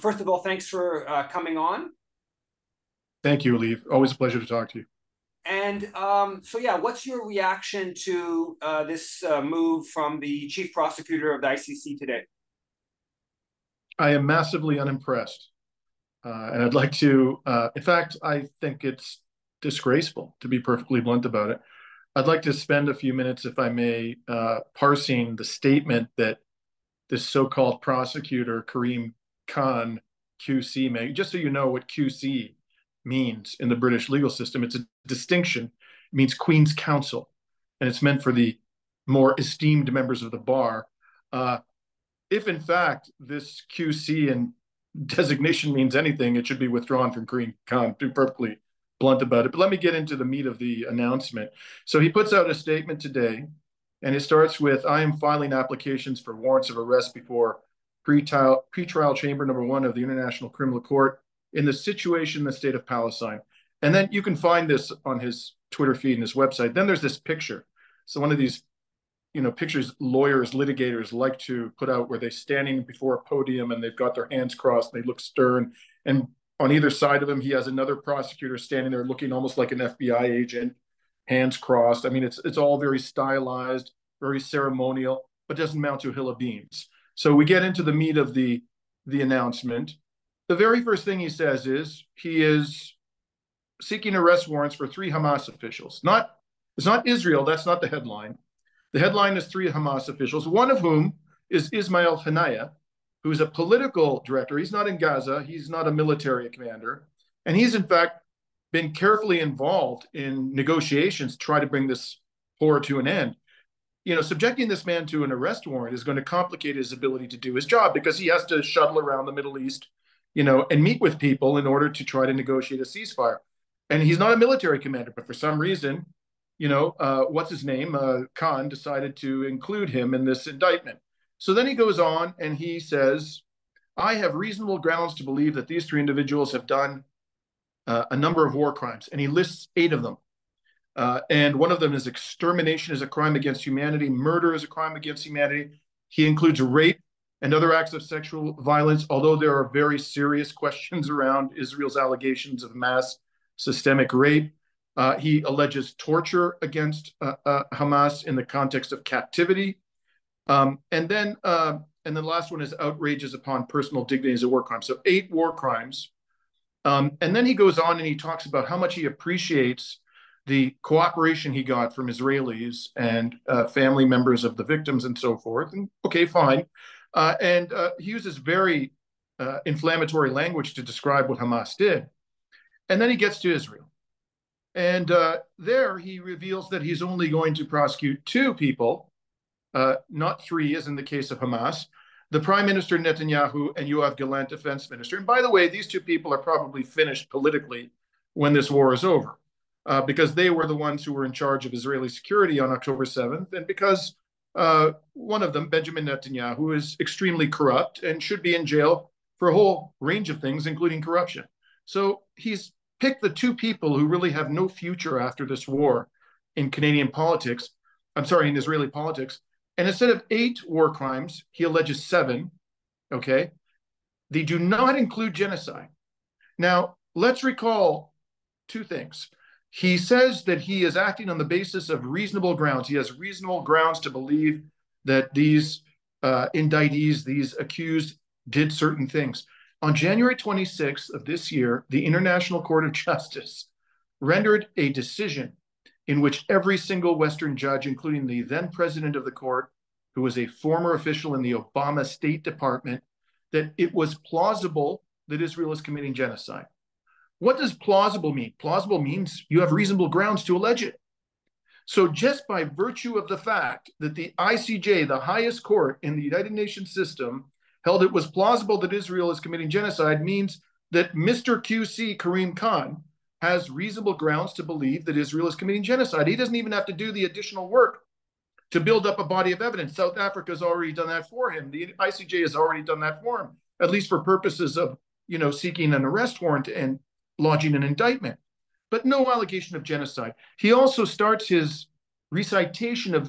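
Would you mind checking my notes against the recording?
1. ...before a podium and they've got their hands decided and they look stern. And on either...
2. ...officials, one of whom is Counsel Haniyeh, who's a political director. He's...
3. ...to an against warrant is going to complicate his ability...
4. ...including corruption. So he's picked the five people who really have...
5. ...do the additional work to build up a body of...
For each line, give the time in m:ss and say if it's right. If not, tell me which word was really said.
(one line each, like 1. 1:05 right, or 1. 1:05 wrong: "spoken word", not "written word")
1. 1:12 wrong: "crossed", not "decided"
2. 1:40 wrong: "Ismail", not "Counsel"
3. 1:55 wrong: "arrest", not "against"
4. 3:30 wrong: "two", not "five"
5. 4:36 right.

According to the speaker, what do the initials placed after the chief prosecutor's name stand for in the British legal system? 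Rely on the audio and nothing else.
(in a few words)
Queen's Counsel.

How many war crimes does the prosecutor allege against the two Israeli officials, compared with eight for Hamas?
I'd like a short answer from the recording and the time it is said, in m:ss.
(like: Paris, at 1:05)
7, at 3:42.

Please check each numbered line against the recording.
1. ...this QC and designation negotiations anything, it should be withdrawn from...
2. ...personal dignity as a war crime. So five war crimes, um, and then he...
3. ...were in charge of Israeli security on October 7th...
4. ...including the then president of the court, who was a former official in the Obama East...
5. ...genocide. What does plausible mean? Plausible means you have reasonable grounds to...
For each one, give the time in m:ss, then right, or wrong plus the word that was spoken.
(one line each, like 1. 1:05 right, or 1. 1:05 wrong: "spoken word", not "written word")
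1. 0:43 wrong: "means", not "negotiations"
2. 2:43 wrong: "eight", not "five"
3. 3:21 right
4. 4:07 wrong: "State", not "East"
5. 4:16 right.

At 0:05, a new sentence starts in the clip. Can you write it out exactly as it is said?
And um, so, yeah, what's your reaction to uh, this uh, move from the chief prosecutor of the ICC today?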